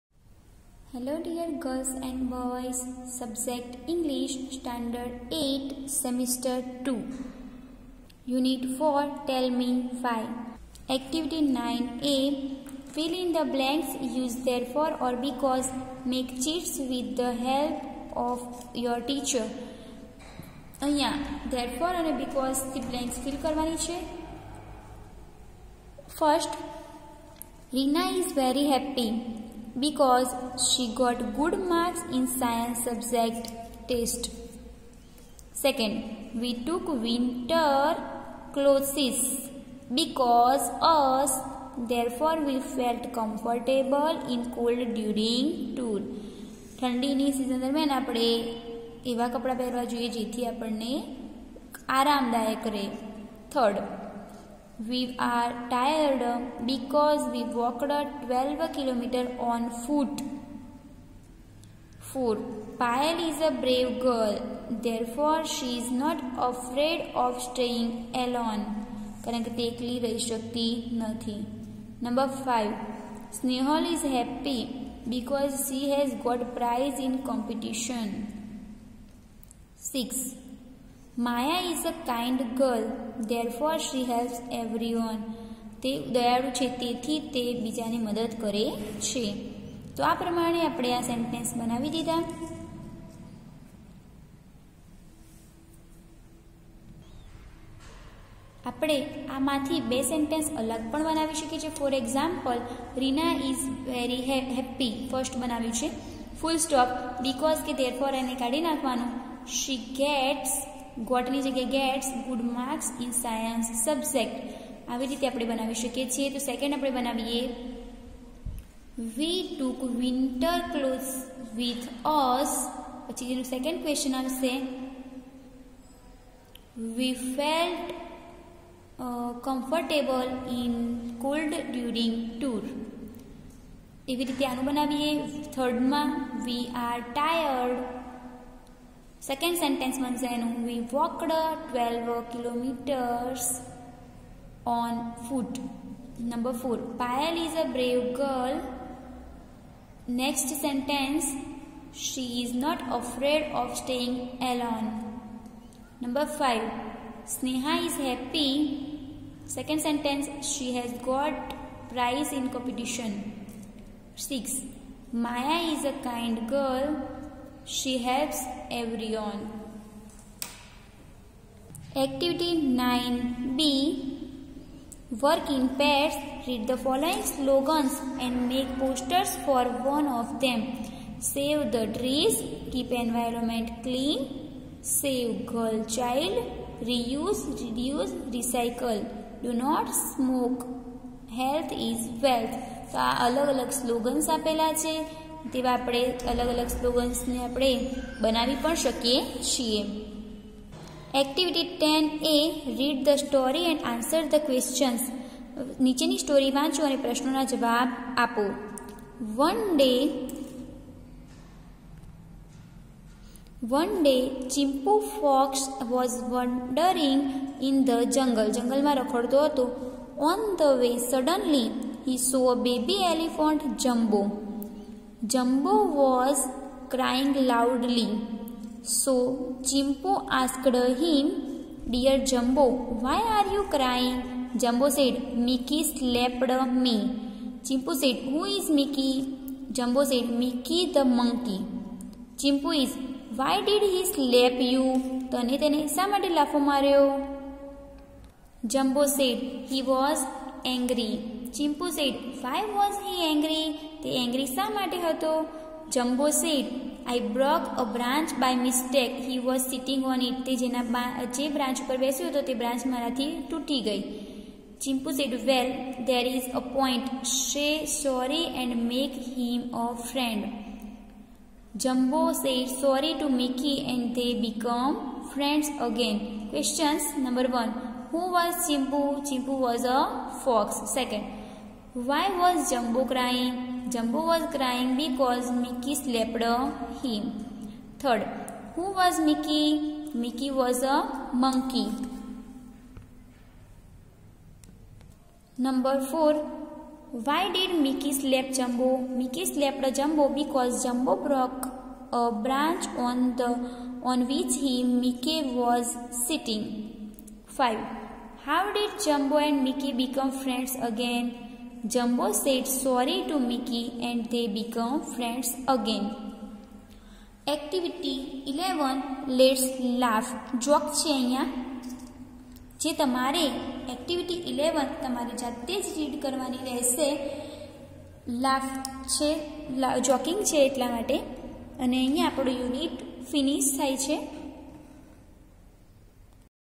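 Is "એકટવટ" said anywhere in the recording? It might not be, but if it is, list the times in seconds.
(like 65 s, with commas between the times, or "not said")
201 s, 317 s, 323 s.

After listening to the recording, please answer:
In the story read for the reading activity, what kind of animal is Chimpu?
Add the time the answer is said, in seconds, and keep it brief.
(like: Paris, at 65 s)
A fox, at 279 s.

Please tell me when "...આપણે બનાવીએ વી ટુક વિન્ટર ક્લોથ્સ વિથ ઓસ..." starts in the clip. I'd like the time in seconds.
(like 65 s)
116 s.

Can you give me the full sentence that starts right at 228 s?
So Chimpo asked him, Dear Jumbo, why are you crying?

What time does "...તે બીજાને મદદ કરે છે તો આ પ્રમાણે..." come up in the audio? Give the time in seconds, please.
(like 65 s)
87 s.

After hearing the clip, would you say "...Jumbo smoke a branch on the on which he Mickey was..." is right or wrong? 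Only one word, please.
wrong.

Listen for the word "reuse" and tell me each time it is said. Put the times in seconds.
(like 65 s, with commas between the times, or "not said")
186 s.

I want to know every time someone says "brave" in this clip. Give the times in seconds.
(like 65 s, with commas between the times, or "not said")
63 s, 147 s.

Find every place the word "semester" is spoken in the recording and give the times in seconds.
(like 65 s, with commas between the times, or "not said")
5 s.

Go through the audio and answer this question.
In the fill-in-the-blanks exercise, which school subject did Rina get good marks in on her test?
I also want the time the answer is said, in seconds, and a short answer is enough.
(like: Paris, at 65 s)
Science, at 32 s.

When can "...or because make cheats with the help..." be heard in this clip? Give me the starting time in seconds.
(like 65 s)
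15 s.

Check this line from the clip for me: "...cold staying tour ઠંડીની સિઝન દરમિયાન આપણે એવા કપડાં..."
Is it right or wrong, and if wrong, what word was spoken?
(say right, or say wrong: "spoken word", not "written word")
wrong: "during", not "staying".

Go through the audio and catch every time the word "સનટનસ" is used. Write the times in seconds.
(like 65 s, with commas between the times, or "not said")
91 s, 100 s.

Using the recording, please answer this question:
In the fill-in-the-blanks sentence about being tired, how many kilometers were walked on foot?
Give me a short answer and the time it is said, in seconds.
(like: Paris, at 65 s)
12 km, at 57 s.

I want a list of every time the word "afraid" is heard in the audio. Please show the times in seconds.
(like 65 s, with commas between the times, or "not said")
66 s, 152 s.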